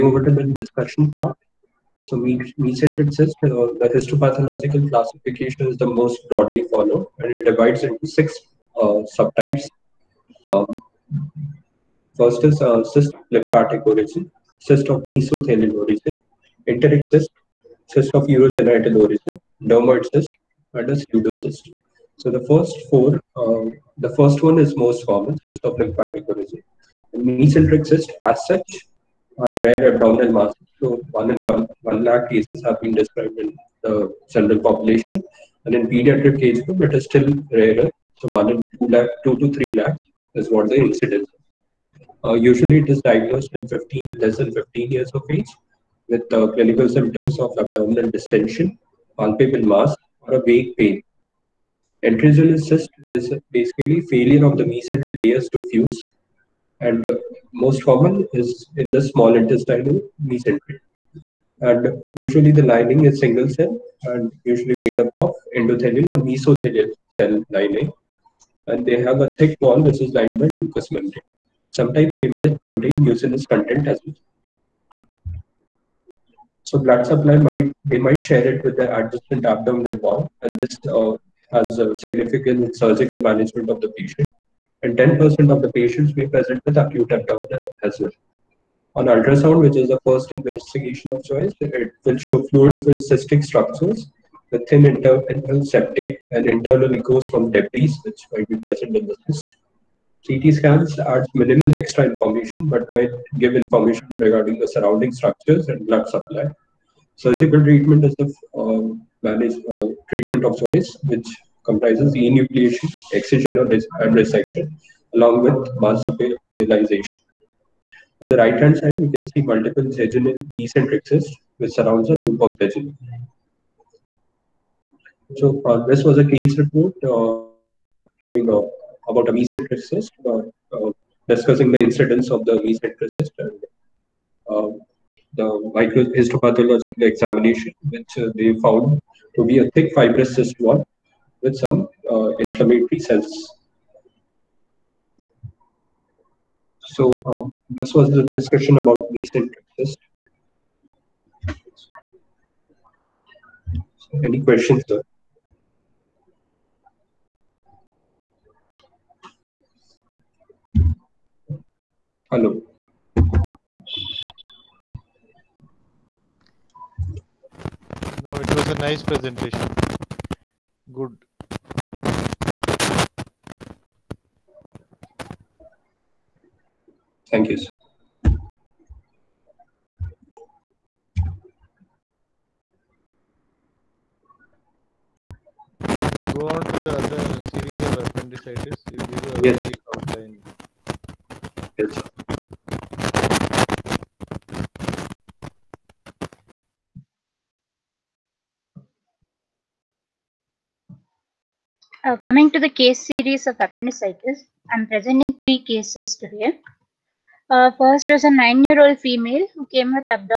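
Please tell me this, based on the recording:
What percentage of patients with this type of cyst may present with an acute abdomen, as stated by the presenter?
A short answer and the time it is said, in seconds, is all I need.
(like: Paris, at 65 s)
10%, at 84 s.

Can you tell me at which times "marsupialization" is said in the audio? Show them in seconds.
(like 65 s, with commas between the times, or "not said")
115 s.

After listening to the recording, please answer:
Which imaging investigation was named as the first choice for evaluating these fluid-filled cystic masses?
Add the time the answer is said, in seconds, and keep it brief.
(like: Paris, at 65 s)
Ultrasound, at 89 s.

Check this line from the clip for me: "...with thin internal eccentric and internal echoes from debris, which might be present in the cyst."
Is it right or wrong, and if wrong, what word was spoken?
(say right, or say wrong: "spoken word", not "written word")
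wrong: "septic", not "eccentric".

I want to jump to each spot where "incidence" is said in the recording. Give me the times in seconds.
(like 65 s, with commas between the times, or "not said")
40 s, 131 s.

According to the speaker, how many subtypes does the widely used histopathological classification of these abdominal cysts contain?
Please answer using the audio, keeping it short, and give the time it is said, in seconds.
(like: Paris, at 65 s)
6, at 8 s.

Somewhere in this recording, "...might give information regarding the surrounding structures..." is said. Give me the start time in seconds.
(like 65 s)
102 s.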